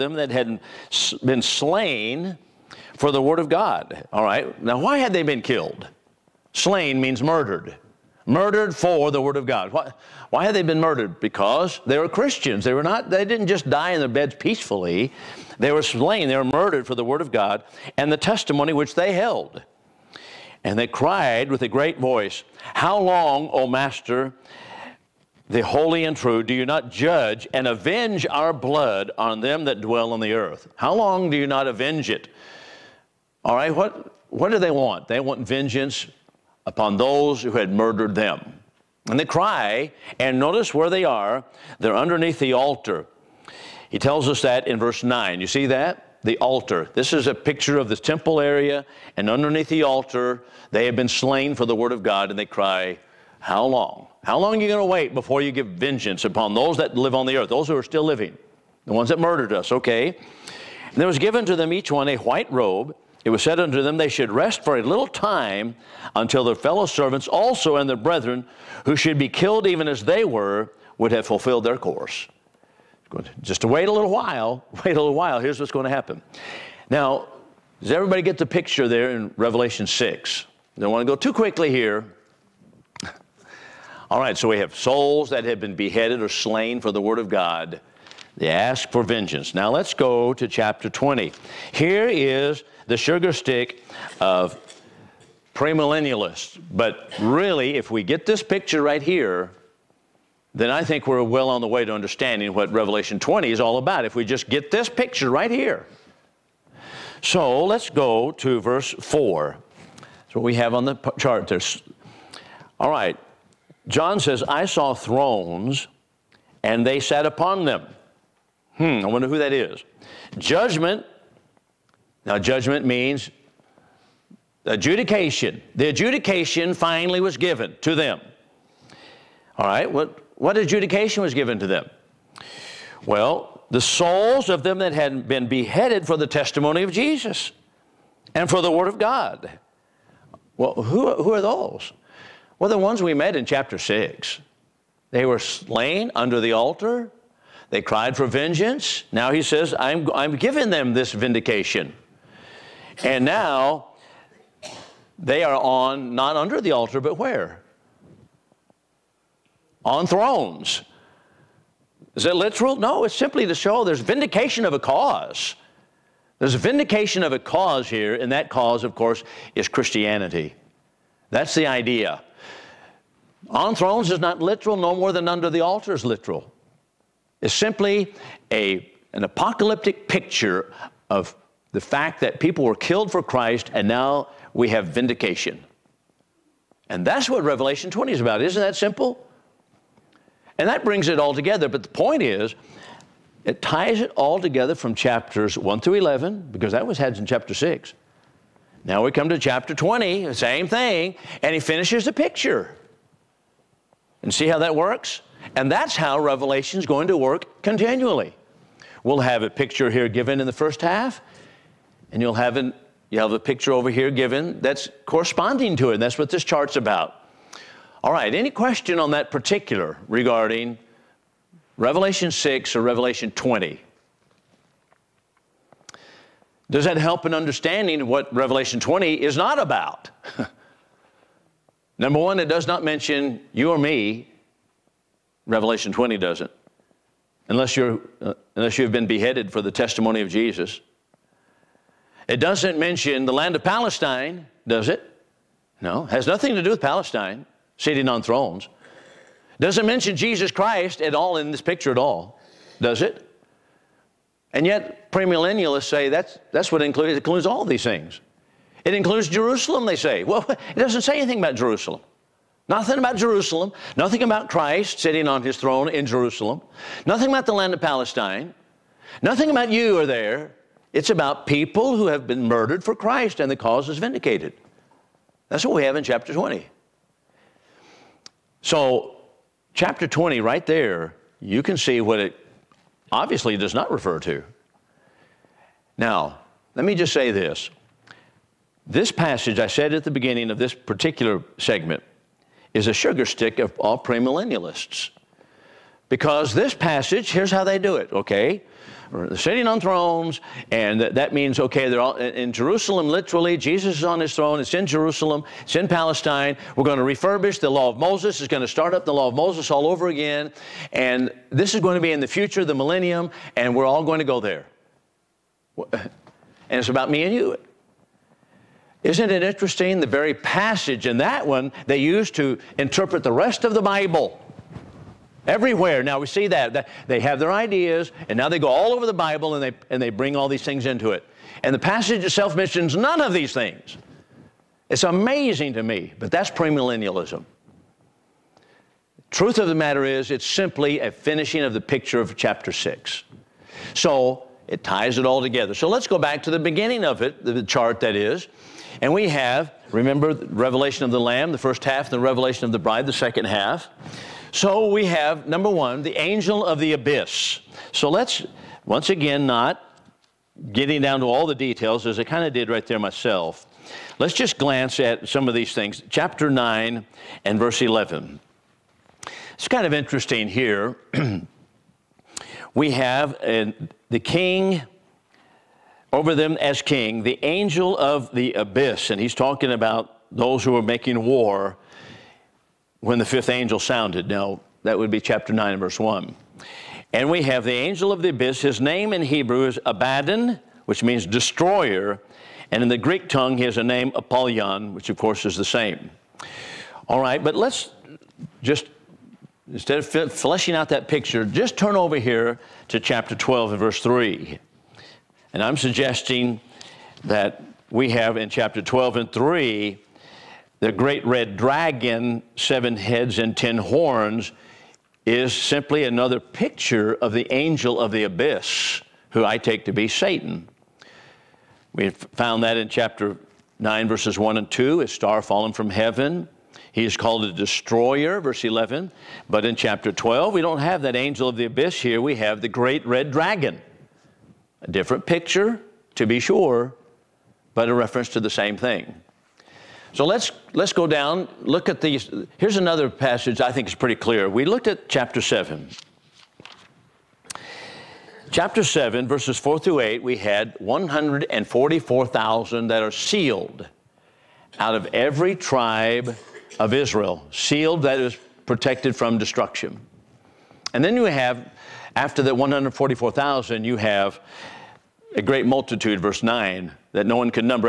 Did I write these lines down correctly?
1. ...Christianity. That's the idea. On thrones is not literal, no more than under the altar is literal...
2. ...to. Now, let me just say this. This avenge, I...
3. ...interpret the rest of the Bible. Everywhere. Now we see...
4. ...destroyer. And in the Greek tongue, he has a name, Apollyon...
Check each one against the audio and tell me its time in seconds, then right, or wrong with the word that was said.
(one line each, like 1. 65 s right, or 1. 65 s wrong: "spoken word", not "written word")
1. 169 s right
2. 284 s wrong: "passage", not "avenge"
3. 322 s right
4. 391 s right.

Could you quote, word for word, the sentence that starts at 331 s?
And the passage itself mentions none of these things.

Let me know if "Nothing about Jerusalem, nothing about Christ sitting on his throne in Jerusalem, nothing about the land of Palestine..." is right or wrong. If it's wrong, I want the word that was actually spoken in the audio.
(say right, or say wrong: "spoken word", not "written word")
right.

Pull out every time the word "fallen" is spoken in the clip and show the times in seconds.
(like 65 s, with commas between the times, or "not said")
425 s.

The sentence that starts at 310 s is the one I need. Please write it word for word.
And this is going to be in the future, the millennium, and we're all going to go there.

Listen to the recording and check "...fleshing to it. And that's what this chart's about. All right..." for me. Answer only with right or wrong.
wrong.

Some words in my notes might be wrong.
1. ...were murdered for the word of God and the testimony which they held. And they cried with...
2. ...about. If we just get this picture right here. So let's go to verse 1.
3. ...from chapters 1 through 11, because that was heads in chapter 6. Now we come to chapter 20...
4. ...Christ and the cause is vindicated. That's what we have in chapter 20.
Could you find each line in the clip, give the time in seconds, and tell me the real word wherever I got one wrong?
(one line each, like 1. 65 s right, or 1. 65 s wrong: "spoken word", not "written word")
1. 16 s right
2. 103 s wrong: "4", not "1"
3. 194 s right
4. 272 s right.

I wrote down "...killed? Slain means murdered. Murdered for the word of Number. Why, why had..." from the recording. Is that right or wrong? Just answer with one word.
wrong.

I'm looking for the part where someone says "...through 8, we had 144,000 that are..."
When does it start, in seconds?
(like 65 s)
449 s.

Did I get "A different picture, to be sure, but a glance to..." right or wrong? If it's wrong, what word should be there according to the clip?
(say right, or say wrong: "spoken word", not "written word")
wrong: "reference", not "glance".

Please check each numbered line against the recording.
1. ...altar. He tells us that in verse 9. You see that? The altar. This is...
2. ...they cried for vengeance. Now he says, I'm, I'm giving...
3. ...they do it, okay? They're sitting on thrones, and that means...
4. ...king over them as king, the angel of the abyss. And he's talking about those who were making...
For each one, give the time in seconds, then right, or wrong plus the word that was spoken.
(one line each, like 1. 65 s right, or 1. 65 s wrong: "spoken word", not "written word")
1. 42 s right
2. 147 s right
3. 297 s right
4. 374 s right.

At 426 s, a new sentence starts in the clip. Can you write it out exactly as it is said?
He is called a destroyer, verse 11.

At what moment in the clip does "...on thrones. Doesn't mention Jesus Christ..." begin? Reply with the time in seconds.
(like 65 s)
248 s.